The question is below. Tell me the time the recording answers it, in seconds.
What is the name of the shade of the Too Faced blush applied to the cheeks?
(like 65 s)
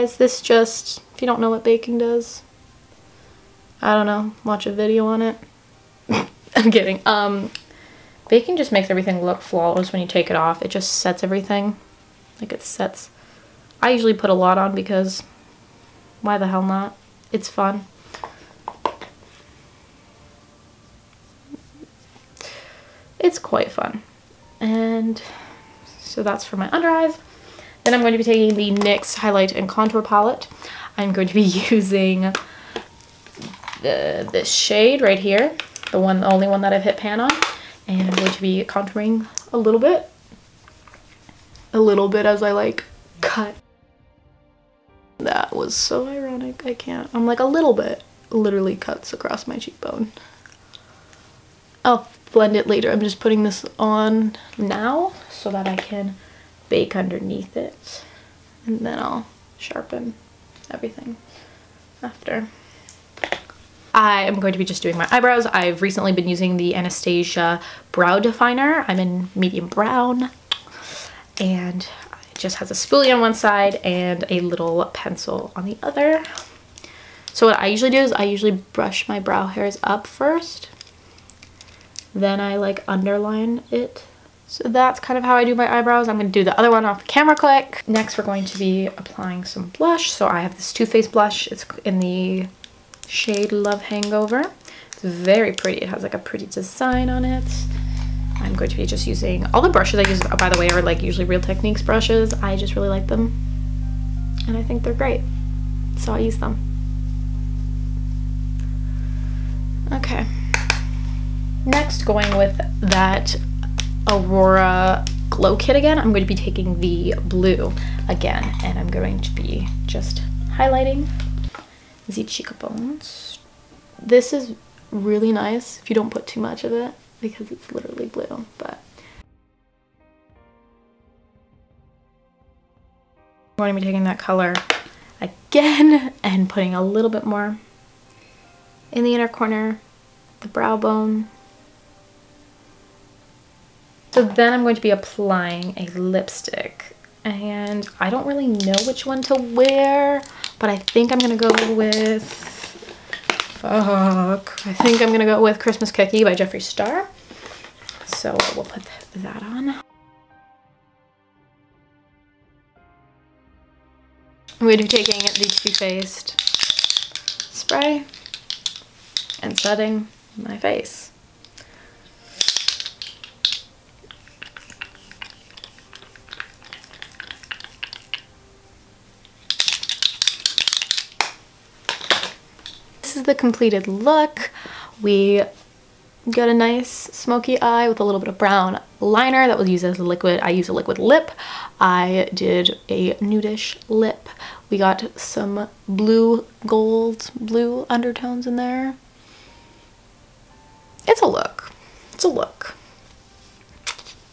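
93 s.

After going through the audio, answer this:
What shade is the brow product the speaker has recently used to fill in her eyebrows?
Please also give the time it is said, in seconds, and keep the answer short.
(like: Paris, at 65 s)
Medium brown, at 69 s.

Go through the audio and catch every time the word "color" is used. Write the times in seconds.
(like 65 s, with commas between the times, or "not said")
134 s.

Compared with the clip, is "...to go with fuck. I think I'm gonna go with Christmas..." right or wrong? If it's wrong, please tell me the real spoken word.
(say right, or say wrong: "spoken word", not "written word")
right.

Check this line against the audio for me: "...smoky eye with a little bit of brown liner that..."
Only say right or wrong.
right.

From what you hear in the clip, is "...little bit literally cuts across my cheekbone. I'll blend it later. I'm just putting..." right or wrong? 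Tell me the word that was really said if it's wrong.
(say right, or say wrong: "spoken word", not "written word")
right.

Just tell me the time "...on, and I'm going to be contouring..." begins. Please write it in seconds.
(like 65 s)
37 s.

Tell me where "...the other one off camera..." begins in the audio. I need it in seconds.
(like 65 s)
86 s.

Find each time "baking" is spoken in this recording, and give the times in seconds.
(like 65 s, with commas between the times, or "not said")
1 s, 8 s.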